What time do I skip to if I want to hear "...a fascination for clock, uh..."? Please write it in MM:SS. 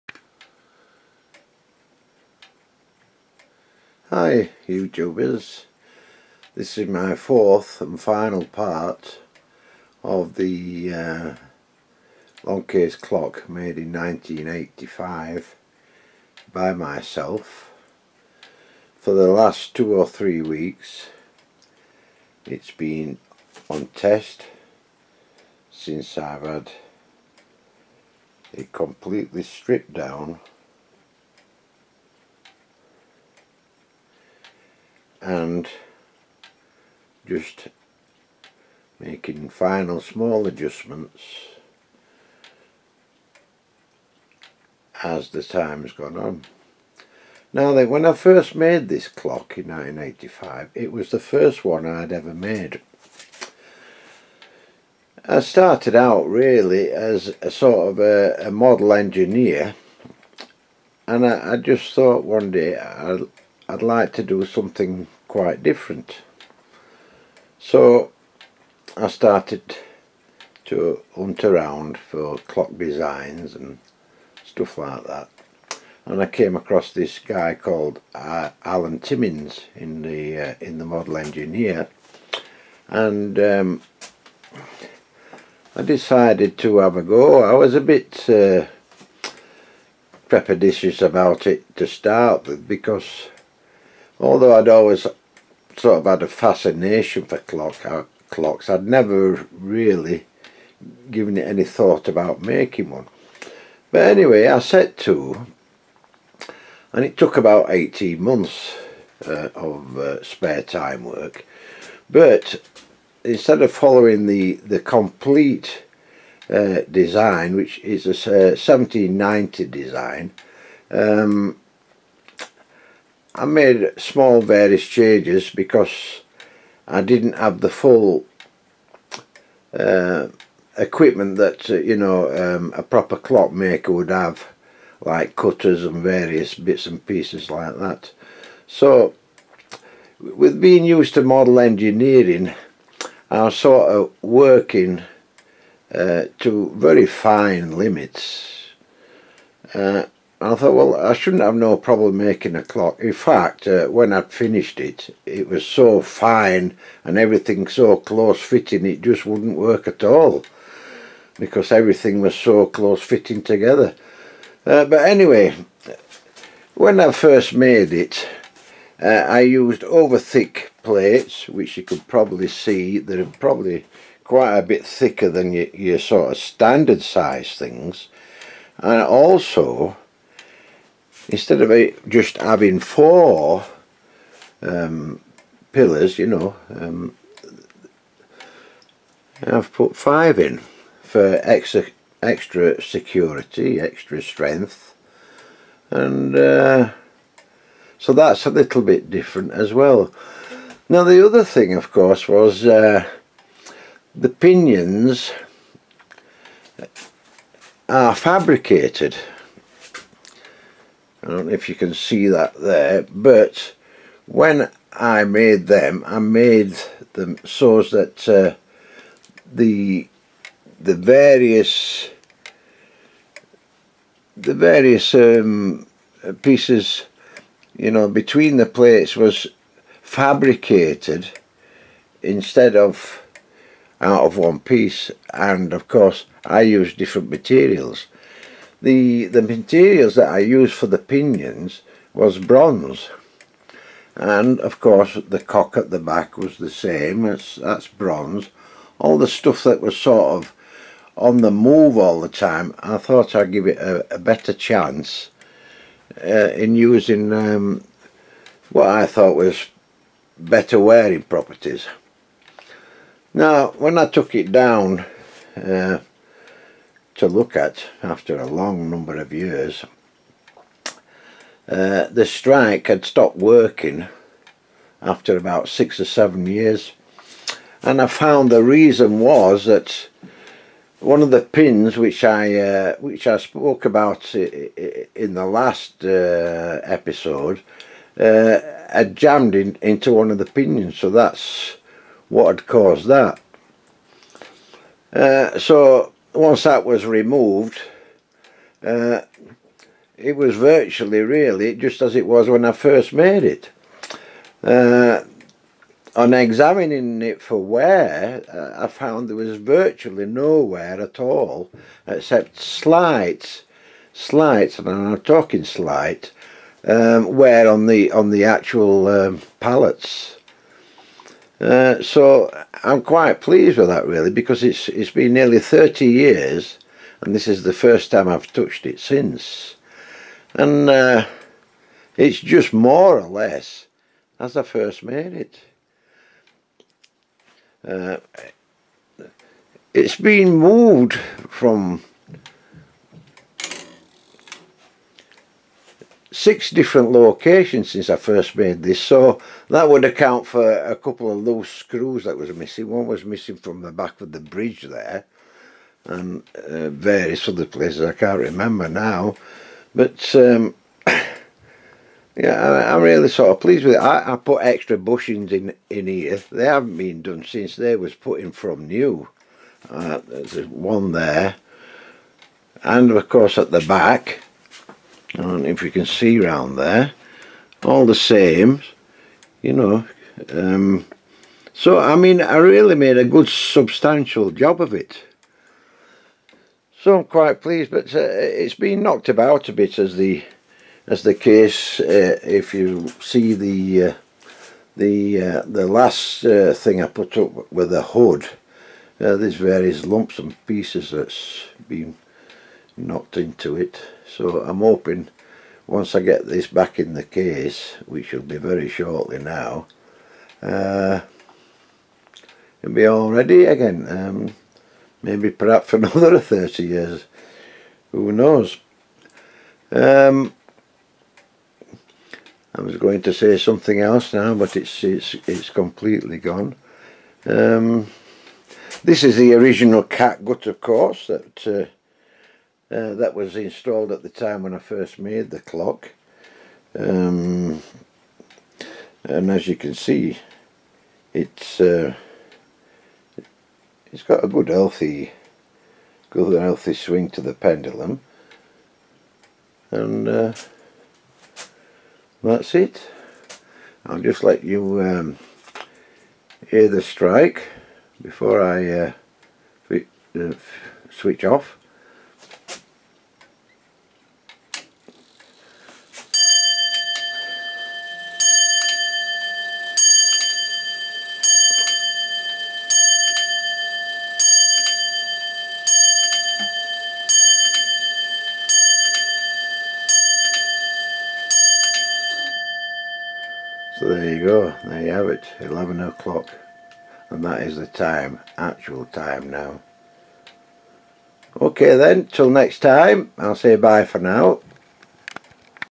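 01:36.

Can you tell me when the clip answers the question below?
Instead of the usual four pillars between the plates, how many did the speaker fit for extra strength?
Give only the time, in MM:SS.
03:09.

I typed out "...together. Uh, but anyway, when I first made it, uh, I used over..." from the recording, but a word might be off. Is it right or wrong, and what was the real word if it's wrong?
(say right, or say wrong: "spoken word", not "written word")
right.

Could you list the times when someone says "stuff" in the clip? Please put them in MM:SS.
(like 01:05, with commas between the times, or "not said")
01:14, 04:09.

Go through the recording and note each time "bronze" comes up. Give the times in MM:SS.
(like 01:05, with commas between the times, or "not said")
04:02, 04:07.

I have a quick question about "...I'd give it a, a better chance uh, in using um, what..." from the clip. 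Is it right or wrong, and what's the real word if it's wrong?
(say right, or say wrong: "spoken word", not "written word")
right.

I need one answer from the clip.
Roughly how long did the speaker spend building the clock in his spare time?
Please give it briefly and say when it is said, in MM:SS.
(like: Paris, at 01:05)
18 months, at 01:47.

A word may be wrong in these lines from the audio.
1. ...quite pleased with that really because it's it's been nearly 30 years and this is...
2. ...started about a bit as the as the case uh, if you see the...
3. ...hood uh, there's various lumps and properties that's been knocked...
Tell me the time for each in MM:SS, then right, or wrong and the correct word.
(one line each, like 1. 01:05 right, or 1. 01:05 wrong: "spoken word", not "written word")
1. 05:23 right
2. 06:29 wrong: "knocked", not "started"
3. 06:38 wrong: "pieces", not "properties".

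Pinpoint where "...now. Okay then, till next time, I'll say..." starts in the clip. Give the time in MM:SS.
08:09.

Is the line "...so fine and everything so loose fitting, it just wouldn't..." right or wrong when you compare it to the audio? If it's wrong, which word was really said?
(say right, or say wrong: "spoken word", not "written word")
wrong: "close", not "loose".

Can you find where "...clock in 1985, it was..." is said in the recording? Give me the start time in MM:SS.
00:49.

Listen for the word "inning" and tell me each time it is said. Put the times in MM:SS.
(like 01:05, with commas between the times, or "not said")
not said.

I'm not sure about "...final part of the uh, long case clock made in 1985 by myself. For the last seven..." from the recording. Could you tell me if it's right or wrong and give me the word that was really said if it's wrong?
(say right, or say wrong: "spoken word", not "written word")
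wrong: "two", not "seven".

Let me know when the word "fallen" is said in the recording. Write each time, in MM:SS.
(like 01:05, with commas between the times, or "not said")
not said.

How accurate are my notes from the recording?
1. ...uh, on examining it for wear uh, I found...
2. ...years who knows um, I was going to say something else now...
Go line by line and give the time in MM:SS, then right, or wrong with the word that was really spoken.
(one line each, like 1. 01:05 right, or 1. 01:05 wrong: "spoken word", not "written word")
1. 05:04 right
2. 06:56 right.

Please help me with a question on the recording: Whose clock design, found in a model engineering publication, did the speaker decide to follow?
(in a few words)
Alan Timmins.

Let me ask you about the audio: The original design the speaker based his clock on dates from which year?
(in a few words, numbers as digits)
1790.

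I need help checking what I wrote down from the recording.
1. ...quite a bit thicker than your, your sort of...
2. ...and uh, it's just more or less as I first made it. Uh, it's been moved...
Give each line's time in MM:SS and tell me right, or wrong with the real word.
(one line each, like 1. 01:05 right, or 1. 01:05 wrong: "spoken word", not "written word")
1. 02:54 right
2. 05:30 right.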